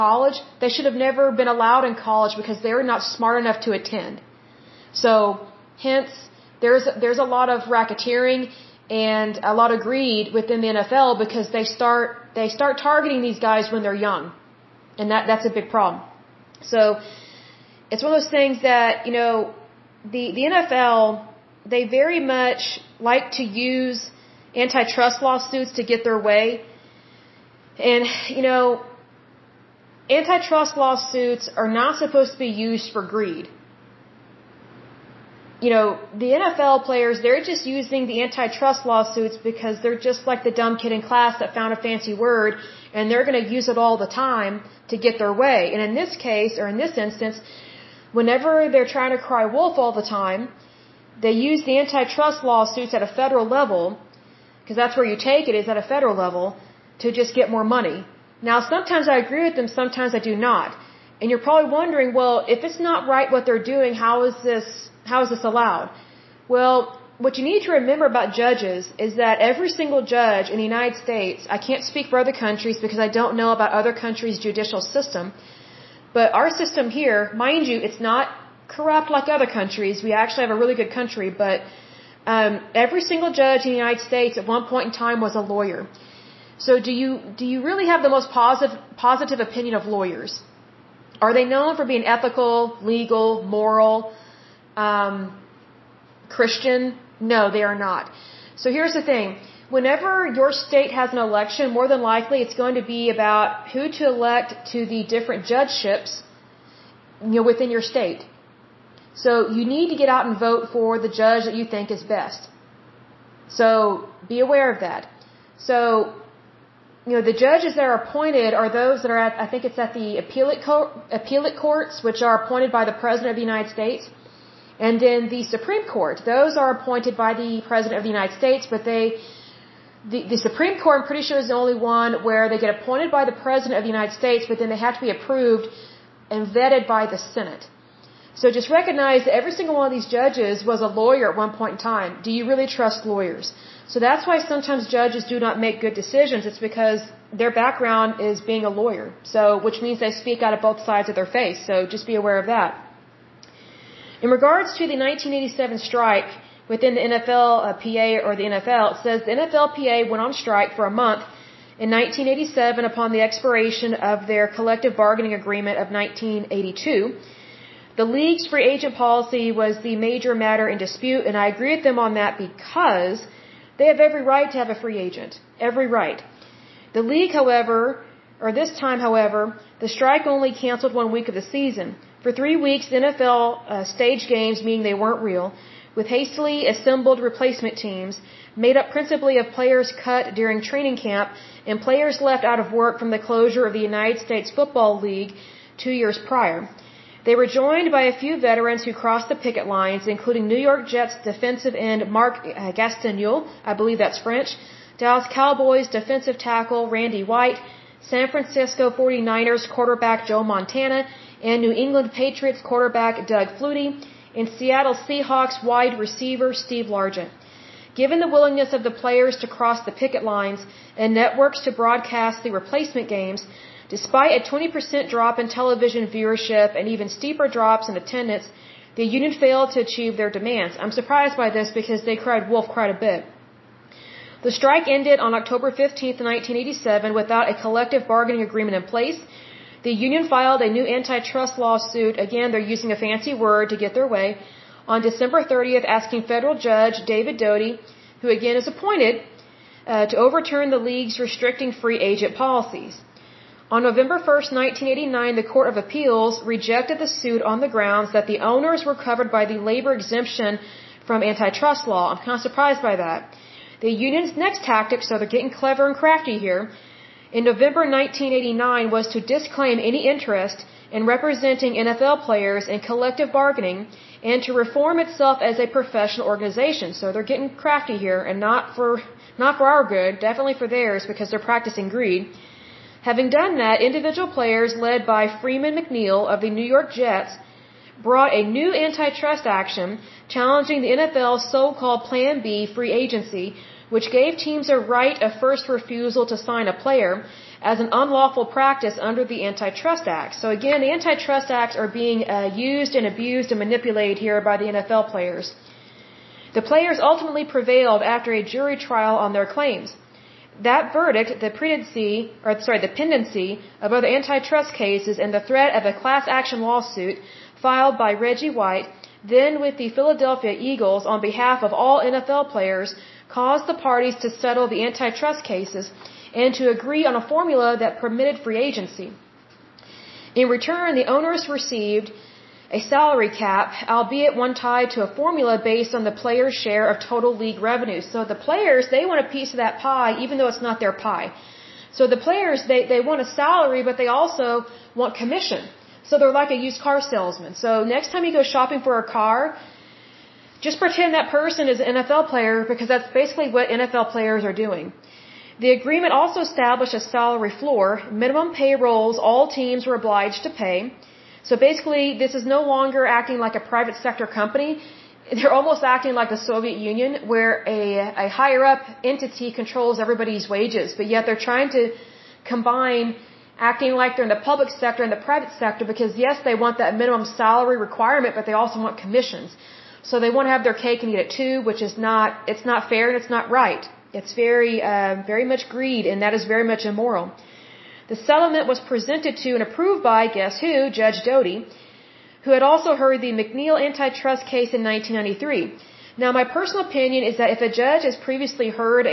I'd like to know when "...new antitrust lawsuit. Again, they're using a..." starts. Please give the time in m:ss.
4:00.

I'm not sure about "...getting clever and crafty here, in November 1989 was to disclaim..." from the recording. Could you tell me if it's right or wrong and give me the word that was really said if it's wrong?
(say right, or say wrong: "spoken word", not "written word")
right.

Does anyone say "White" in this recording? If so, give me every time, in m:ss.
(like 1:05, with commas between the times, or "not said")
3:27, 5:18.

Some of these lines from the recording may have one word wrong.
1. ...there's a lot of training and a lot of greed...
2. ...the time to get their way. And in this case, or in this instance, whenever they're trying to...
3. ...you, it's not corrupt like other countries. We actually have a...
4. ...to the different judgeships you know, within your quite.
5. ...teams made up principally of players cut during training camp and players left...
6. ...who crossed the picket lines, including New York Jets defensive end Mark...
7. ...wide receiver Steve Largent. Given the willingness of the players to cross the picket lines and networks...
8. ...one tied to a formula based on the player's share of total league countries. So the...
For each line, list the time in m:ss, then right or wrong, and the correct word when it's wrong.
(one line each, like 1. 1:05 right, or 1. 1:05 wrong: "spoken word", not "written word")
1. 0:07 wrong: "racketeering", not "training"
2. 0:43 right
3. 1:17 right
4. 1:44 wrong: "state", not "quite"
5. 3:07 right
6. 3:18 right
7. 3:35 right
8. 5:34 wrong: "revenues", not "countries".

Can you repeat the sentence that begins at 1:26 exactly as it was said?
So do you do you really have the most positive positive opinion of lawyers?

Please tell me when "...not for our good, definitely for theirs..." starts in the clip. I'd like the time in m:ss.
4:39.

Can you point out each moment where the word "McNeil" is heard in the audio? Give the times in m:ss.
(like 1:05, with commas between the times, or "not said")
4:45, 6:33.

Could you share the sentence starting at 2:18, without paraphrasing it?
So just recognize that every single one of these judges was a lawyer at one point in time.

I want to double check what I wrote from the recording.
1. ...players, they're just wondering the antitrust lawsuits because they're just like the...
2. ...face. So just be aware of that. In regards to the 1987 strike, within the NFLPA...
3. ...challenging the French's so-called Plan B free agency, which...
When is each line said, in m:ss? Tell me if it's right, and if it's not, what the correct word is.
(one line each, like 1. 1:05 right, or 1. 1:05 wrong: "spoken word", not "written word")
1. 0:36 wrong: "using", not "wondering"
2. 2:31 right
3. 4:50 wrong: "NFL", not "French".